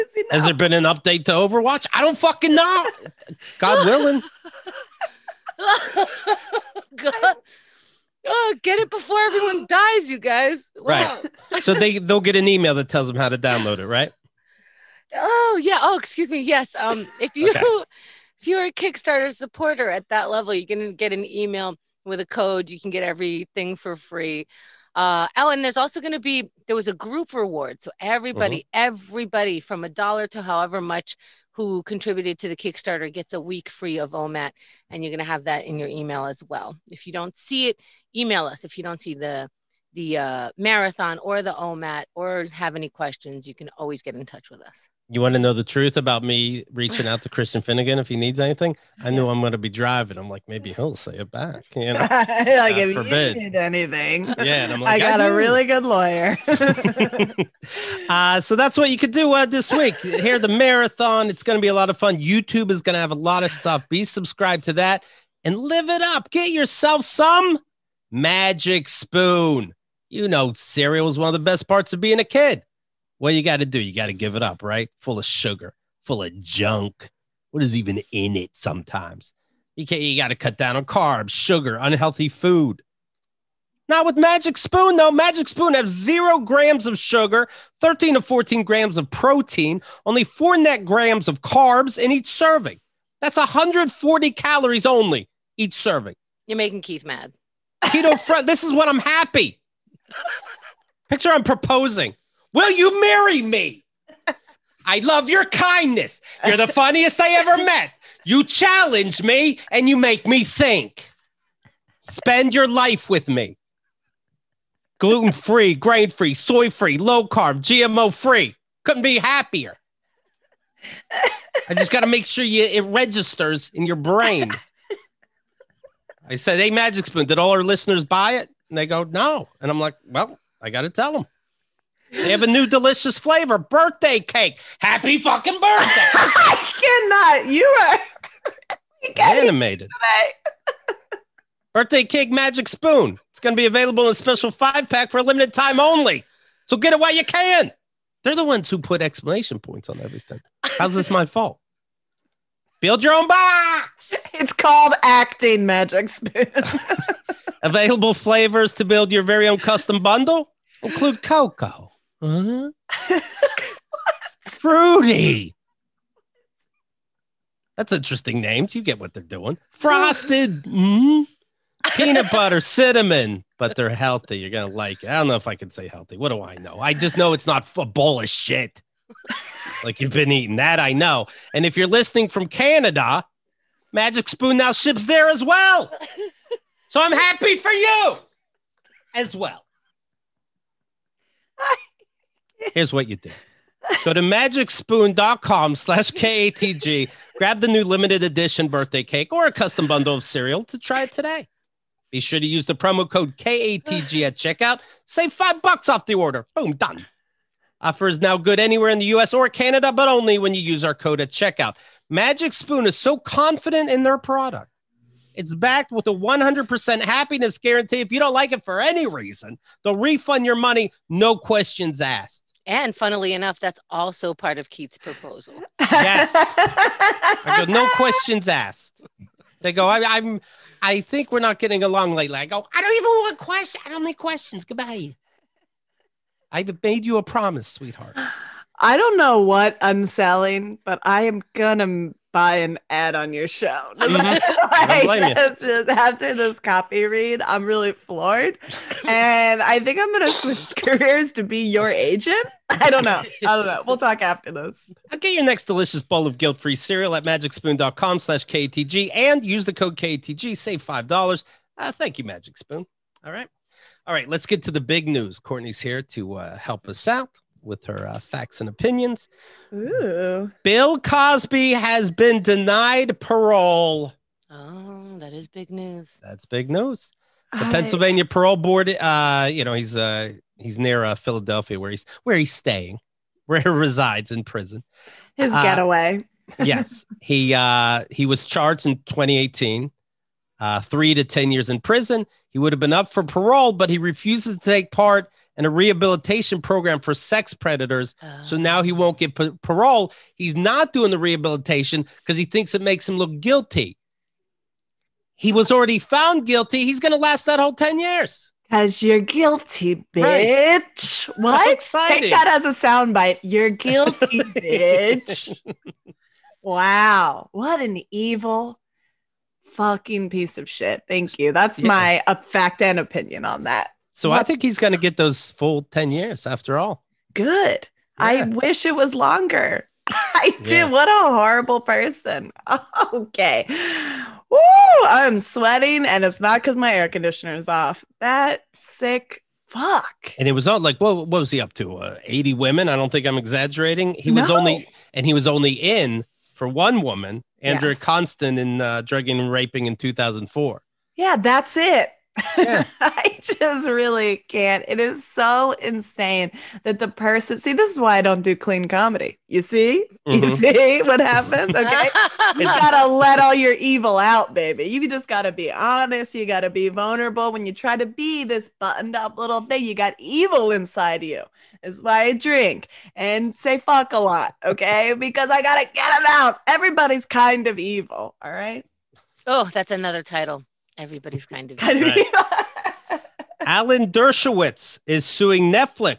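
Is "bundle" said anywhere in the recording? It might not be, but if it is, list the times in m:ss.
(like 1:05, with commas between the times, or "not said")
2:40, 3:19.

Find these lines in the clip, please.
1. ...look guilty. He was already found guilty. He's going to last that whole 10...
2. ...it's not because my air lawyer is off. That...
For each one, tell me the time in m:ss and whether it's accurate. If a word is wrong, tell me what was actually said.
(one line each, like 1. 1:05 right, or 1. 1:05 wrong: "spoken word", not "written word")
1. 5:03 right
2. 5:36 wrong: "conditioner", not "lawyer".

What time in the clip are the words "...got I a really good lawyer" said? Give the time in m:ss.
0:55.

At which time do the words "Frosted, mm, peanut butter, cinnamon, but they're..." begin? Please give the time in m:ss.
2:49.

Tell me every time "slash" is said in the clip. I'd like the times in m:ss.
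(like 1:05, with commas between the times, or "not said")
3:15, 4:18.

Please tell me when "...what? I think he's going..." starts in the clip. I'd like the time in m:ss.
5:24.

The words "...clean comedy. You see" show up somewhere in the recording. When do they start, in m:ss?
5:58.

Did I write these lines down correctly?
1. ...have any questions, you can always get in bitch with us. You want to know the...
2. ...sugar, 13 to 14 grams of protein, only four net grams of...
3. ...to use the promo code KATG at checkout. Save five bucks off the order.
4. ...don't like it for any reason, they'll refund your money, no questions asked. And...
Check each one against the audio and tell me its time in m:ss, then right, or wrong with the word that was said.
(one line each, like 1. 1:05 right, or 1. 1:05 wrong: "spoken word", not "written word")
1. 0:42 wrong: "touch", not "bitch"
2. 1:26 right
3. 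3:22 right
4. 3:38 right.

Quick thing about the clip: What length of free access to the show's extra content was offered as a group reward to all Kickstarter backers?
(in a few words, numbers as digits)
a week.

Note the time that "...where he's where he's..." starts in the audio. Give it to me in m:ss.
4:41.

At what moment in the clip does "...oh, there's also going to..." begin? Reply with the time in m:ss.
0:25.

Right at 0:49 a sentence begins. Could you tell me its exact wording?
I knew I'm going to be driving.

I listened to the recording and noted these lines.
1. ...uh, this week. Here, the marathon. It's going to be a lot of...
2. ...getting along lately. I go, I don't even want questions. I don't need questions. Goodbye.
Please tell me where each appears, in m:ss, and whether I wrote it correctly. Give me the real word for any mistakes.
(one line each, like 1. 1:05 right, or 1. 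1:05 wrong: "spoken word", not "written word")
1. 0:59 right
2. 3:51 right.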